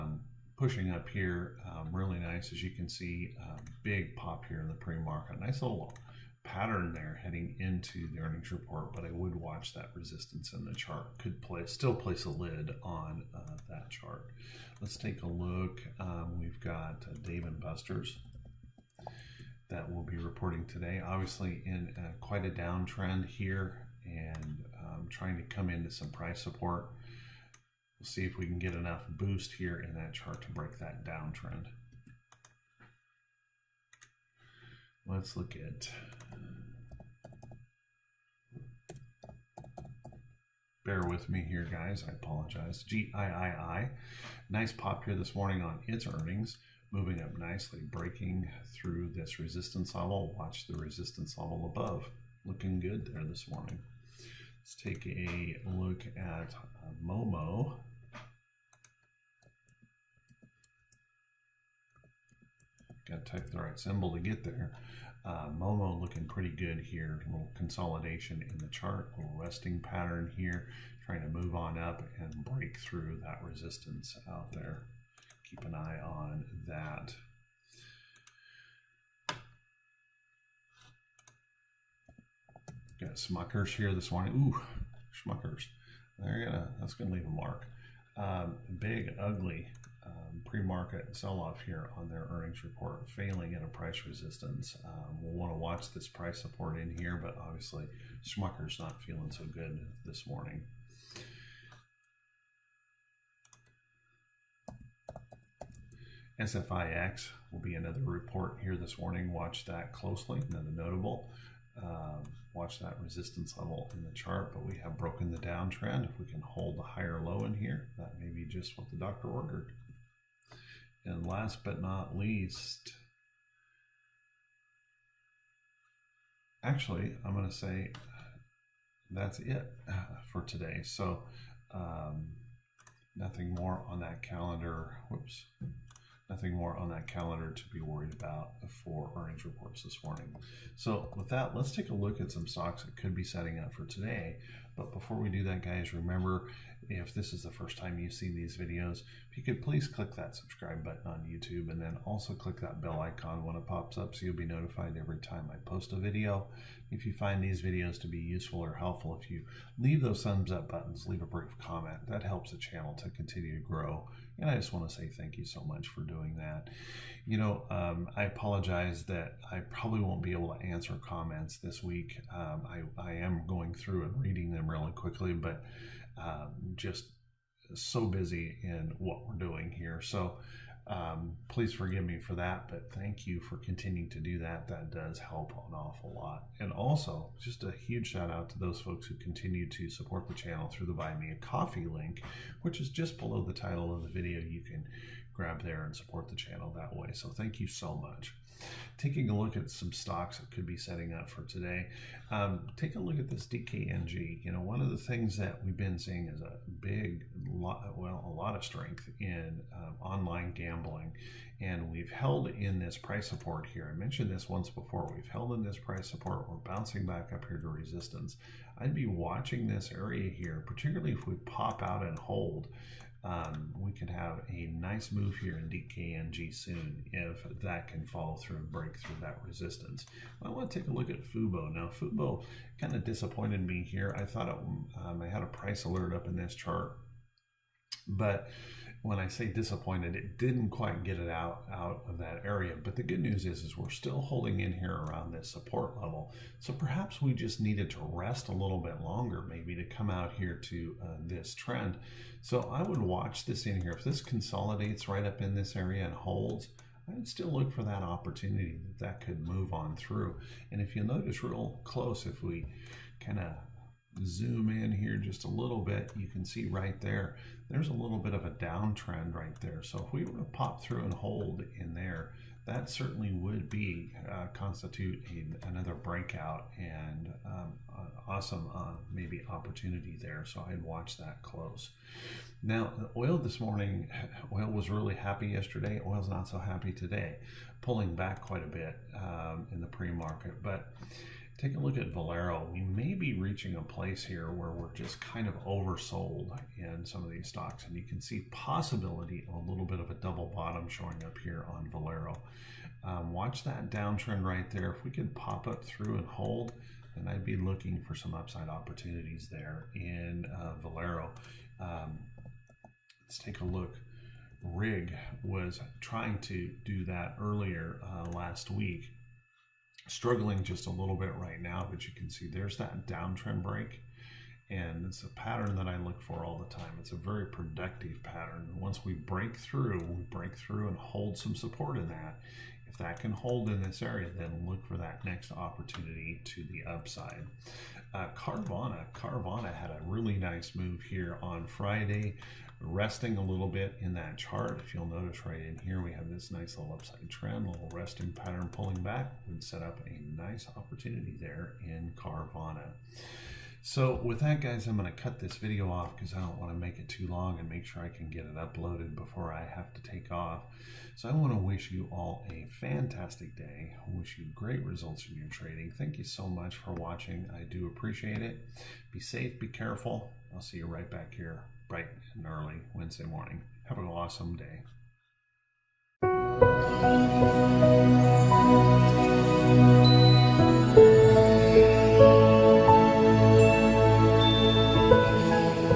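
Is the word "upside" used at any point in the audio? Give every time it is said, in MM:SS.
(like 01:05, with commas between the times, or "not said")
05:08, 05:36, 05:46.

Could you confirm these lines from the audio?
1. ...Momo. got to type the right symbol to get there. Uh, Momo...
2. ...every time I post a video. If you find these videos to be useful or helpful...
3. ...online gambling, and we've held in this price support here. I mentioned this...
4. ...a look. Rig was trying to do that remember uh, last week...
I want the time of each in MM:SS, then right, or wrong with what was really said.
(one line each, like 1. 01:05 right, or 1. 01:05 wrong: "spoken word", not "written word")
1. 00:57 right
2. 02:34 right
3. 03:29 right
4. 05:13 wrong: "earlier", not "remember".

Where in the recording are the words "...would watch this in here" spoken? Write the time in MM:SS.
04:12.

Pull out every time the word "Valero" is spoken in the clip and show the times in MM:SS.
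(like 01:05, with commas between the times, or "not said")
04:52, 05:01, 05:10.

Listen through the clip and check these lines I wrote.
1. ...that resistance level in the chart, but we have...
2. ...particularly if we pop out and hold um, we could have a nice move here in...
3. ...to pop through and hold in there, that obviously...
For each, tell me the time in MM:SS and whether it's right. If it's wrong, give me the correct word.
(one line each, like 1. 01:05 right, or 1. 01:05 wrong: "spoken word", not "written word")
1. 01:52 right
2. 03:40 right
3. 04:30 wrong: "certainly", not "obviously".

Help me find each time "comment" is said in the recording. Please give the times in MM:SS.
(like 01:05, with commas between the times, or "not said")
02:41, 02:51.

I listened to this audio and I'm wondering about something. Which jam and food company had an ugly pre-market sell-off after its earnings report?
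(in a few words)
Smuckers.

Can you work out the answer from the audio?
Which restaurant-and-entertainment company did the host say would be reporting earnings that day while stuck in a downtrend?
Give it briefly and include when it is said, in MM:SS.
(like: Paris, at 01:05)
Dave and Buster's, at 00:17.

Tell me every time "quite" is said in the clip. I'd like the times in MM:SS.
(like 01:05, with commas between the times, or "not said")
00:22, 04:00, 04:48.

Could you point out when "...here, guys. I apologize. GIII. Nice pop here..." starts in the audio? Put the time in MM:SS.
00:41.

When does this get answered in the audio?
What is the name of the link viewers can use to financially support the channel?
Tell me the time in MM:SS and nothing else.
03:10.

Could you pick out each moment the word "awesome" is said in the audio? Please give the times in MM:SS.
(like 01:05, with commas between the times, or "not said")
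04:38, 06:14.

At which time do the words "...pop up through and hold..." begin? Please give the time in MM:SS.
05:05.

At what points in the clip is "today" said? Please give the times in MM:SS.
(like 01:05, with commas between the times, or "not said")
00:20, 02:10, 02:23, 03:21, 04:46.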